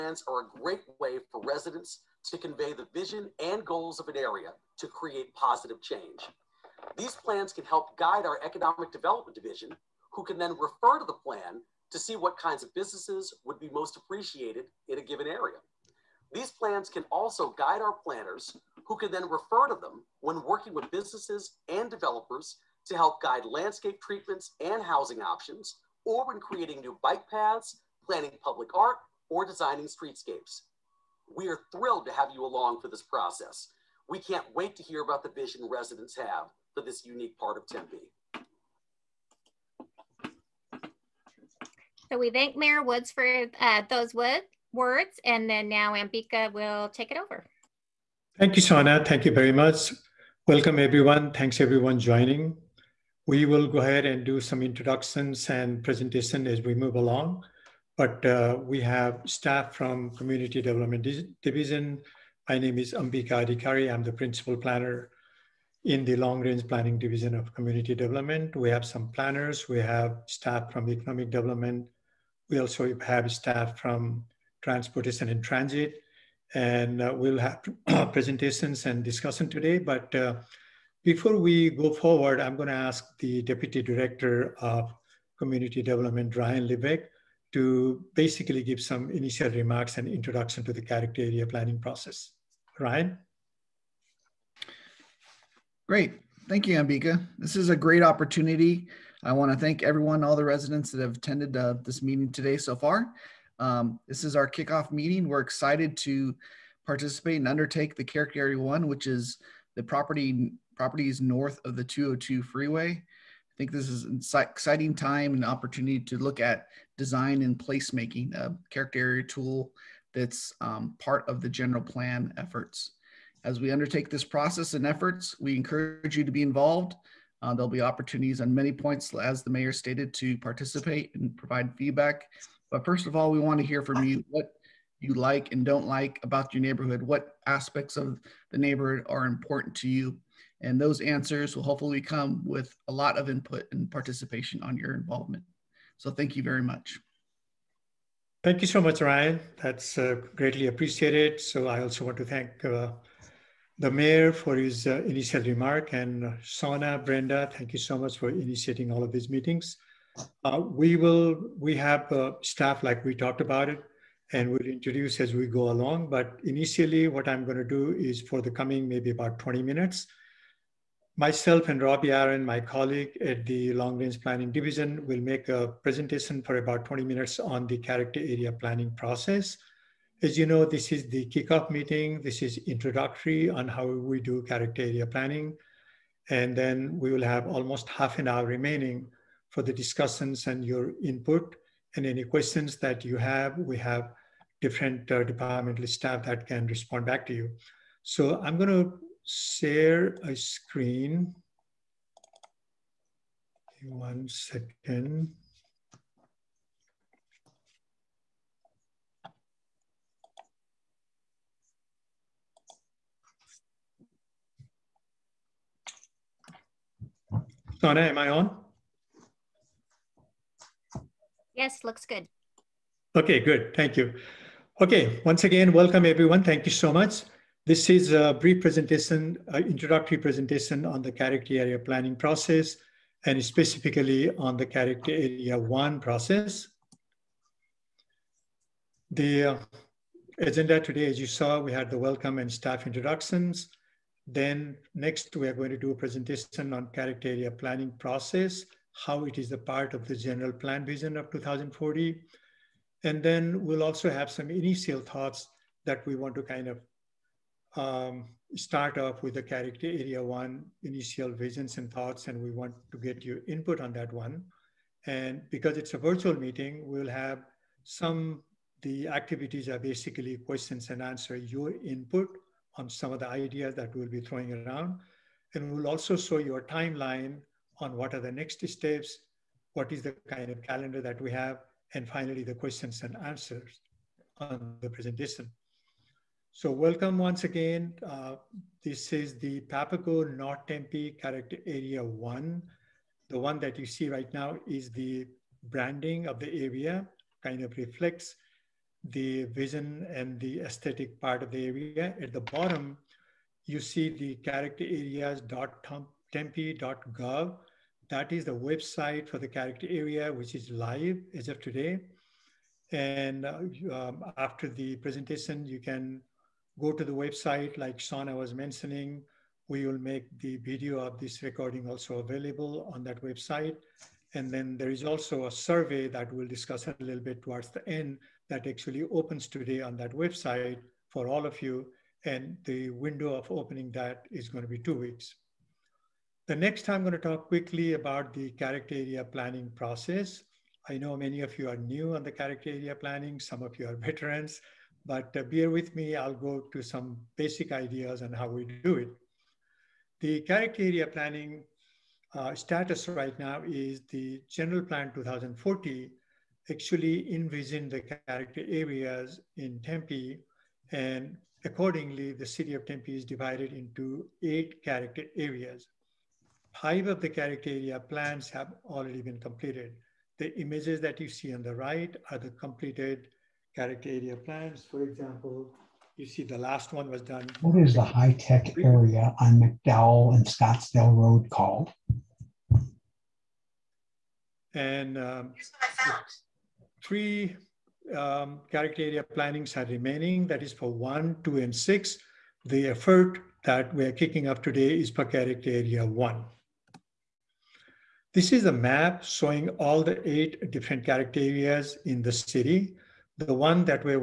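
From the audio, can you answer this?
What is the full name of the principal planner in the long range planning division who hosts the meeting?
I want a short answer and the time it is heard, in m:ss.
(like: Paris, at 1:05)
Ambika Adhikari, at 1:02.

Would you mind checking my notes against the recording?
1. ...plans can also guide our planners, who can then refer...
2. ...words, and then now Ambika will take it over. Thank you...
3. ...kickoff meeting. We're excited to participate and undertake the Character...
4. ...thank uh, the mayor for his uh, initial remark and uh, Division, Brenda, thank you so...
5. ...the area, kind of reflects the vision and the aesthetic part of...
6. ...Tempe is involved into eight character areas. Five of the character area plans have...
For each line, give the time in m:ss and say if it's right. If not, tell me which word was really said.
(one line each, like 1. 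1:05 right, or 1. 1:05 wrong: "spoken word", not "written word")
1. 0:16 right
2. 0:44 right
3. 1:44 right
4. 2:32 wrong: "Sona", not "Division"
5. 4:56 right
6. 6:02 wrong: "divided", not "involved".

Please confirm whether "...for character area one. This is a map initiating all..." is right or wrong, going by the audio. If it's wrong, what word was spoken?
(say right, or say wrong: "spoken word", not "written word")
wrong: "showing", not "initiating".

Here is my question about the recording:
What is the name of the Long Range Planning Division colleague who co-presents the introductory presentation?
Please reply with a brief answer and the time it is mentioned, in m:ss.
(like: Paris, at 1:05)
Robbie Aaron, at 2:51.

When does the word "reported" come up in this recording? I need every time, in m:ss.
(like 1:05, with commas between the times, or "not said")
not said.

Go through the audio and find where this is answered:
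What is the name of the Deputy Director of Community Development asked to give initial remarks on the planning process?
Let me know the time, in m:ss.
1:26.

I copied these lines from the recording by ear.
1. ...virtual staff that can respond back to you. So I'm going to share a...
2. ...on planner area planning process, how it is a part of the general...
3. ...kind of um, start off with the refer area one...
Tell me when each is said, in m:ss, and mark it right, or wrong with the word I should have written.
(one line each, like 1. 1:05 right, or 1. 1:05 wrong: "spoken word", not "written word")
1. 3:15 wrong: "departmental", not "virtual"
2. 4:06 wrong: "character", not "planner"
3. 4:16 wrong: "character", not "refer".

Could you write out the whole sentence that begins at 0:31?
We are thrilled to have you along for this process.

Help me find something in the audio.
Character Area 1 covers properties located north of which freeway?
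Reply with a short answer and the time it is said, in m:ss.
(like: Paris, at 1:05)
the 202, at 1:51.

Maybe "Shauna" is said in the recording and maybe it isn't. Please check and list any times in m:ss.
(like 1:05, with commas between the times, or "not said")
0:48, 5:17.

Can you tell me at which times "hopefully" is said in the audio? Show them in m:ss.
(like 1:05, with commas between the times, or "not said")
2:21.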